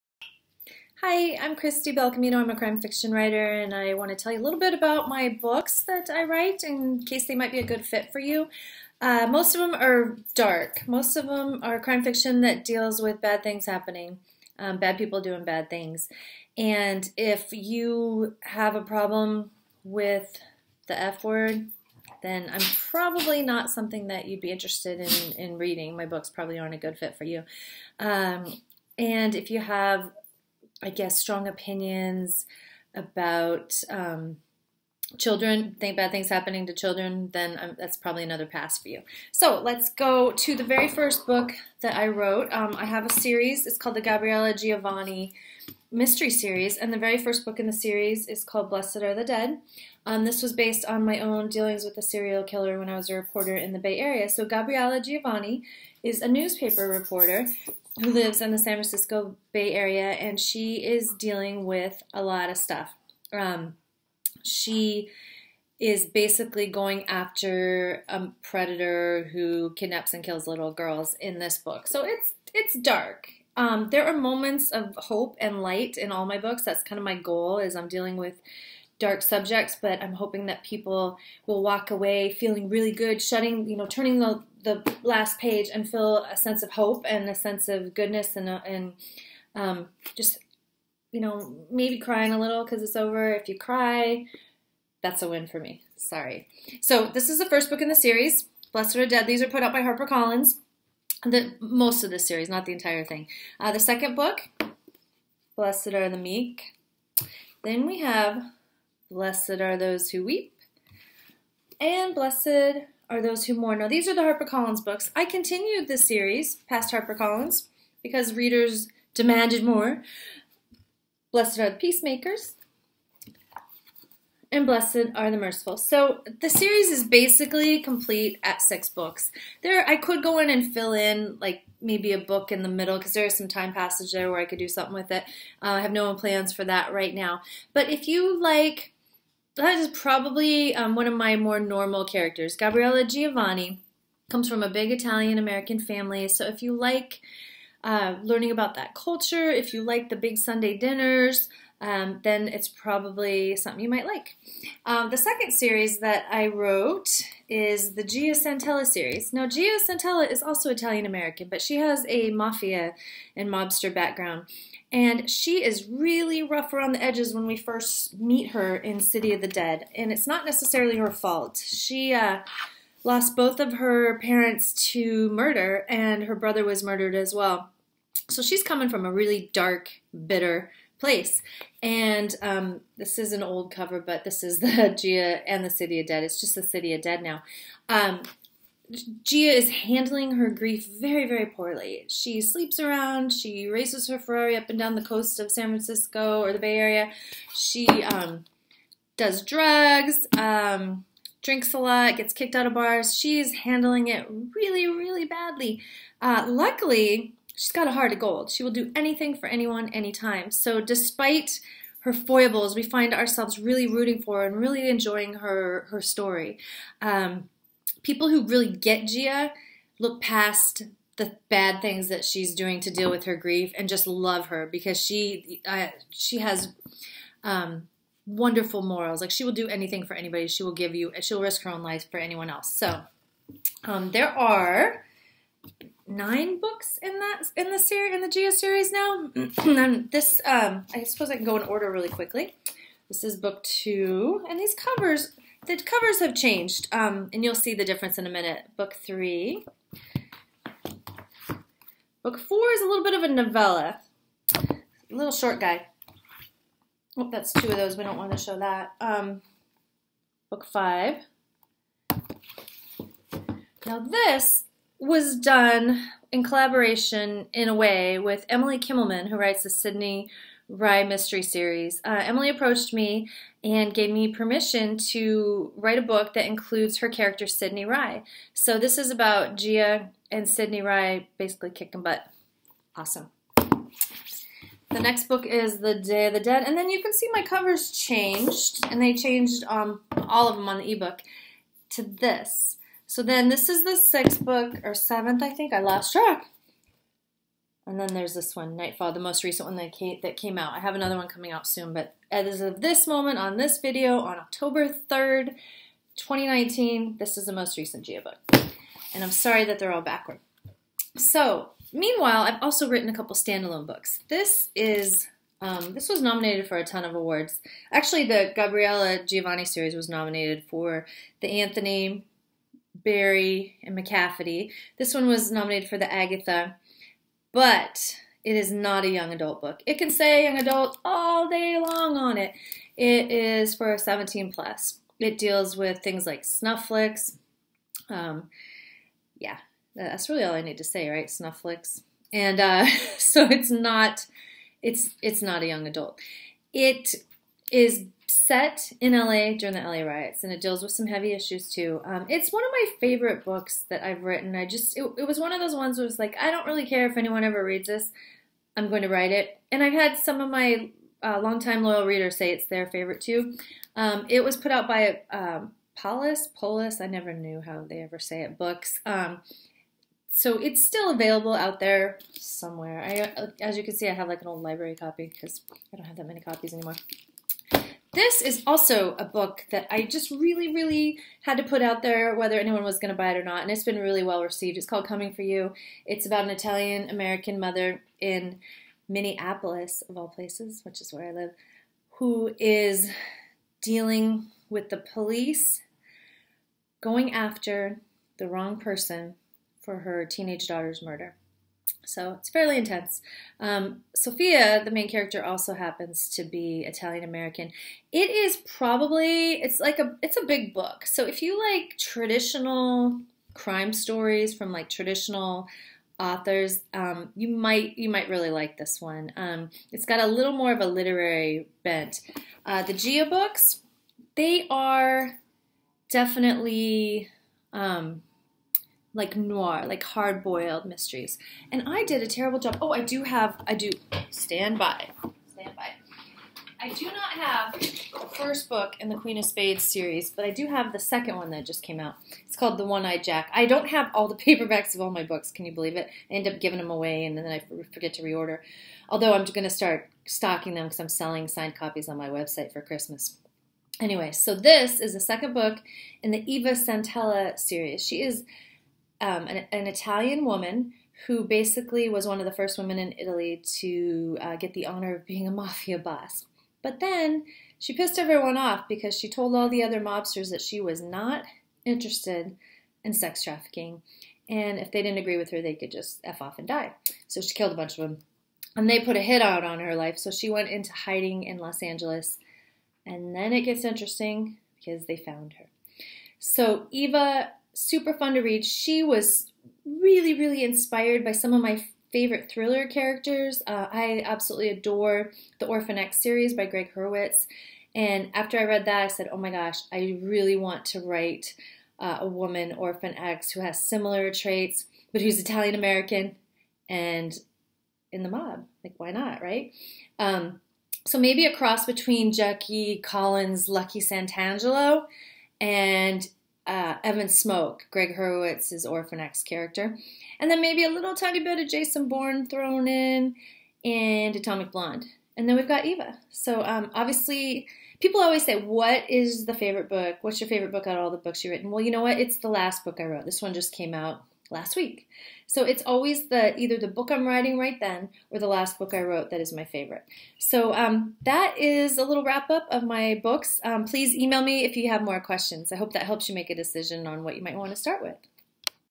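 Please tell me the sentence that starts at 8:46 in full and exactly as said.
So um, obviously, people always say, "What is the favorite book?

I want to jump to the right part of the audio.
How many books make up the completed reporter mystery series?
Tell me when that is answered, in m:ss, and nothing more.
2:08.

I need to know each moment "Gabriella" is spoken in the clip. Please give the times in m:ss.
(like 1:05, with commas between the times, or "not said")
0:44, 0:54, 2:22, 5:18.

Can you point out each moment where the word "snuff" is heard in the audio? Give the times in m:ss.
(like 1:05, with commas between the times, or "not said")
5:36, 5:41.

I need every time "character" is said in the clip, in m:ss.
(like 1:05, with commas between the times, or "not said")
2:22, 4:37, 6:45, 8:12, 8:39.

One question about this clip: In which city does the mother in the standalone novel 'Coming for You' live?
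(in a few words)
Minneapolis.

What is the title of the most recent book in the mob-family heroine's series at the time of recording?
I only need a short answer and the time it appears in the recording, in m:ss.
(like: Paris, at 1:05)
Nightfall, at 4:58.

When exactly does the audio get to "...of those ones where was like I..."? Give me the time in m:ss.
5:55.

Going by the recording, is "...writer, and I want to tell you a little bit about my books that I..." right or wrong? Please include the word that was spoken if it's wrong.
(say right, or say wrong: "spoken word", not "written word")
right.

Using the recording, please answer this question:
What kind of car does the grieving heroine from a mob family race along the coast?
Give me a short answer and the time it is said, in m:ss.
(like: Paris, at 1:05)
Ferrari, at 3:14.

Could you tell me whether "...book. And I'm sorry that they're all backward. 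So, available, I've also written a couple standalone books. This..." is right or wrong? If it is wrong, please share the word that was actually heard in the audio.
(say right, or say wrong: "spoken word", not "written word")
wrong: "meanwhile", not "available".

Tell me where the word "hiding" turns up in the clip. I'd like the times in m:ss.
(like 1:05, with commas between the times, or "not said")
8:00.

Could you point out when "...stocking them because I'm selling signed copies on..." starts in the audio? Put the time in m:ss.
7:30.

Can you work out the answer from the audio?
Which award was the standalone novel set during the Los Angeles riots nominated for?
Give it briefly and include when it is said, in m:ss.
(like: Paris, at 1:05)
Agatha, at 5:26.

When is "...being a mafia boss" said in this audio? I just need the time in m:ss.
7:45.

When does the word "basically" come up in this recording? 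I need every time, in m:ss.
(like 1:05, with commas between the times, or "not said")
1:06, 2:07, 4:41, 7:41.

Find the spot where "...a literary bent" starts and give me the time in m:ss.
7:00.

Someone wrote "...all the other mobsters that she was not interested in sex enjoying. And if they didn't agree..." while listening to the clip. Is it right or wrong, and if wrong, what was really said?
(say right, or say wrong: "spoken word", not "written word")
wrong: "trafficking", not "enjoying".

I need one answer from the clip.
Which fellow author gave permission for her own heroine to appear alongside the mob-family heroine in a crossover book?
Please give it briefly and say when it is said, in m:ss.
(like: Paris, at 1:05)
Emily Kimelman, at 4:28.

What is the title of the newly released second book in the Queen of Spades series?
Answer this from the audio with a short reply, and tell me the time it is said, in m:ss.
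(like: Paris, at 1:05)
The One Eyed Jack, at 7:22.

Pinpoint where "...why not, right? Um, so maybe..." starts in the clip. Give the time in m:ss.
8:28.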